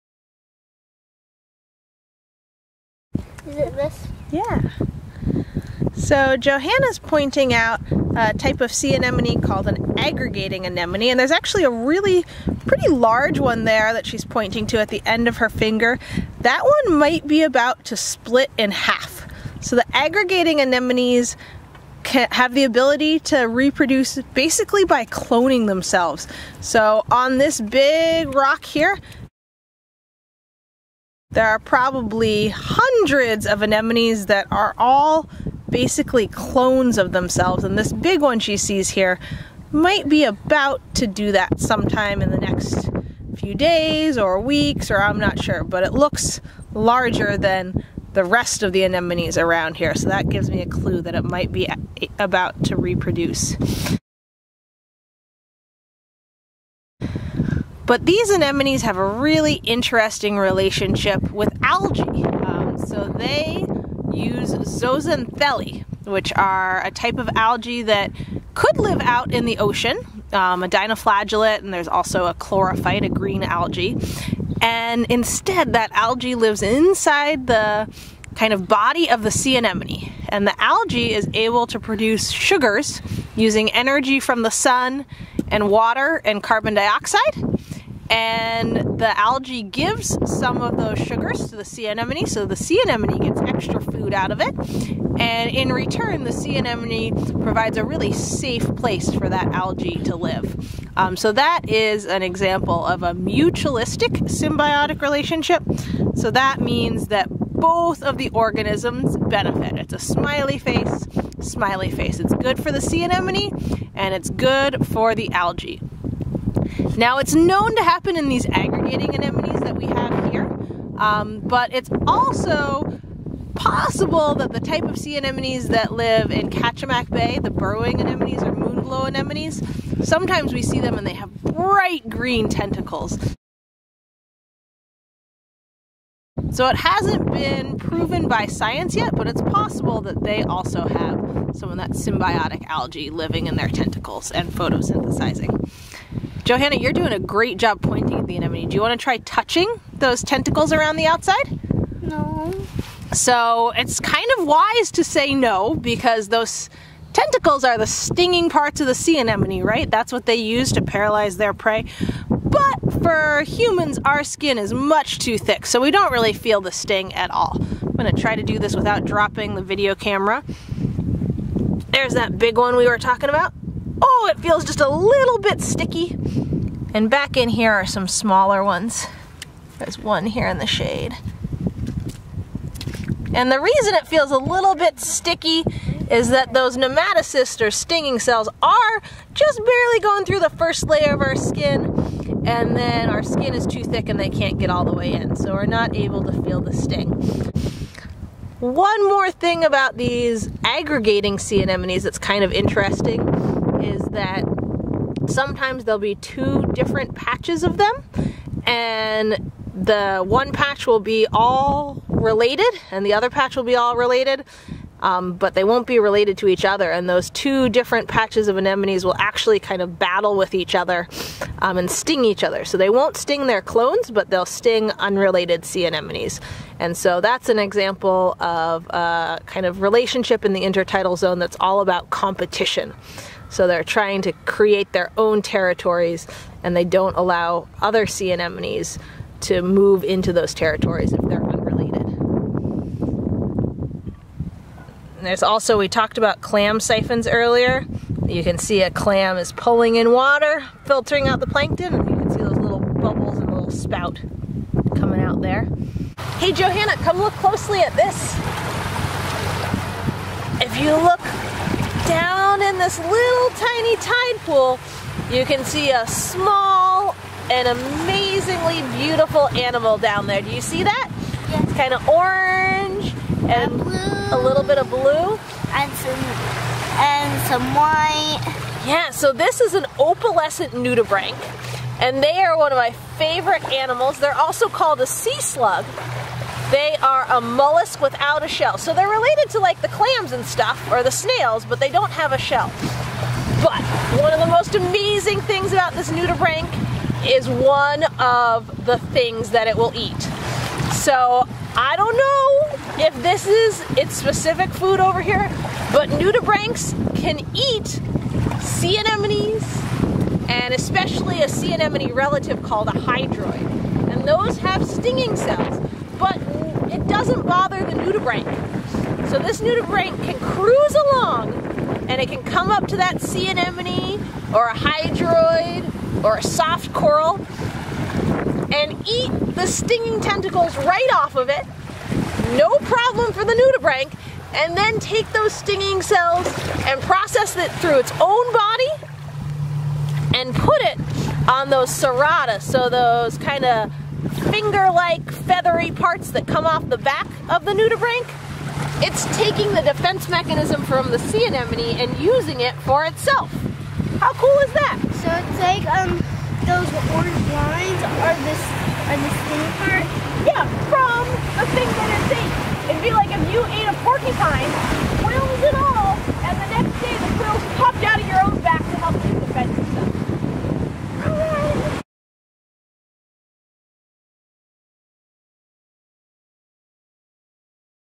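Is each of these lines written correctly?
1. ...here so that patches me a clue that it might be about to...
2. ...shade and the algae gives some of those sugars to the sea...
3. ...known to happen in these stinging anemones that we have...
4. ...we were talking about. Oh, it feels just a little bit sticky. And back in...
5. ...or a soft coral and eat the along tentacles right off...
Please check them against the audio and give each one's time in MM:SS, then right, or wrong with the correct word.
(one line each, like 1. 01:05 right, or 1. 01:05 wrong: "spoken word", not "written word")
1. 00:49 wrong: "gives", not "patches"
2. 01:26 wrong: "dioxide", not "shade"
3. 01:57 wrong: "aggregating", not "stinging"
4. 02:52 right
5. 05:26 wrong: "stinging", not "along".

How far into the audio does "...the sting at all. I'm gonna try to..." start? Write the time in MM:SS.
02:46.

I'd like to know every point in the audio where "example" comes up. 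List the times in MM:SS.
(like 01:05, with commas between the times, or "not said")
01:42, 03:47.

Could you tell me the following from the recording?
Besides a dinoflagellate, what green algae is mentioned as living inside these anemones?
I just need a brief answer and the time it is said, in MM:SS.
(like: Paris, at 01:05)
chlorophyte, at 01:12.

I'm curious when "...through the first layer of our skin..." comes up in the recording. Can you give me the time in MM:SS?
03:10.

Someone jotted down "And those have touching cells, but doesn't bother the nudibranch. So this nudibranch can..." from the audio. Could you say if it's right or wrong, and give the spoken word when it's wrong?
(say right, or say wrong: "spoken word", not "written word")
wrong: "stinging", not "touching".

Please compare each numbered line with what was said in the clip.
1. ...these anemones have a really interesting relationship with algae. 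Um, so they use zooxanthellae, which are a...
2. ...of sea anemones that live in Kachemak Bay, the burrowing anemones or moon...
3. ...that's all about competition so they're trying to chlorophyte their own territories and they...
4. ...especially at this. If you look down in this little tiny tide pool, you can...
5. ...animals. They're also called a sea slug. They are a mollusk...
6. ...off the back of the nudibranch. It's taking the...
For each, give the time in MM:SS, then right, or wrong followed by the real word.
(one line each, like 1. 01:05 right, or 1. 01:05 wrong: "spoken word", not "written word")
1. 00:58 right
2. 02:04 right
3. 03:51 wrong: "create", not "chlorophyte"
4. 04:17 wrong: "closely", not "especially"
5. 04:43 right
6. 05:46 right.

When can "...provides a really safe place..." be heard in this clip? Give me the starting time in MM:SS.
01:37.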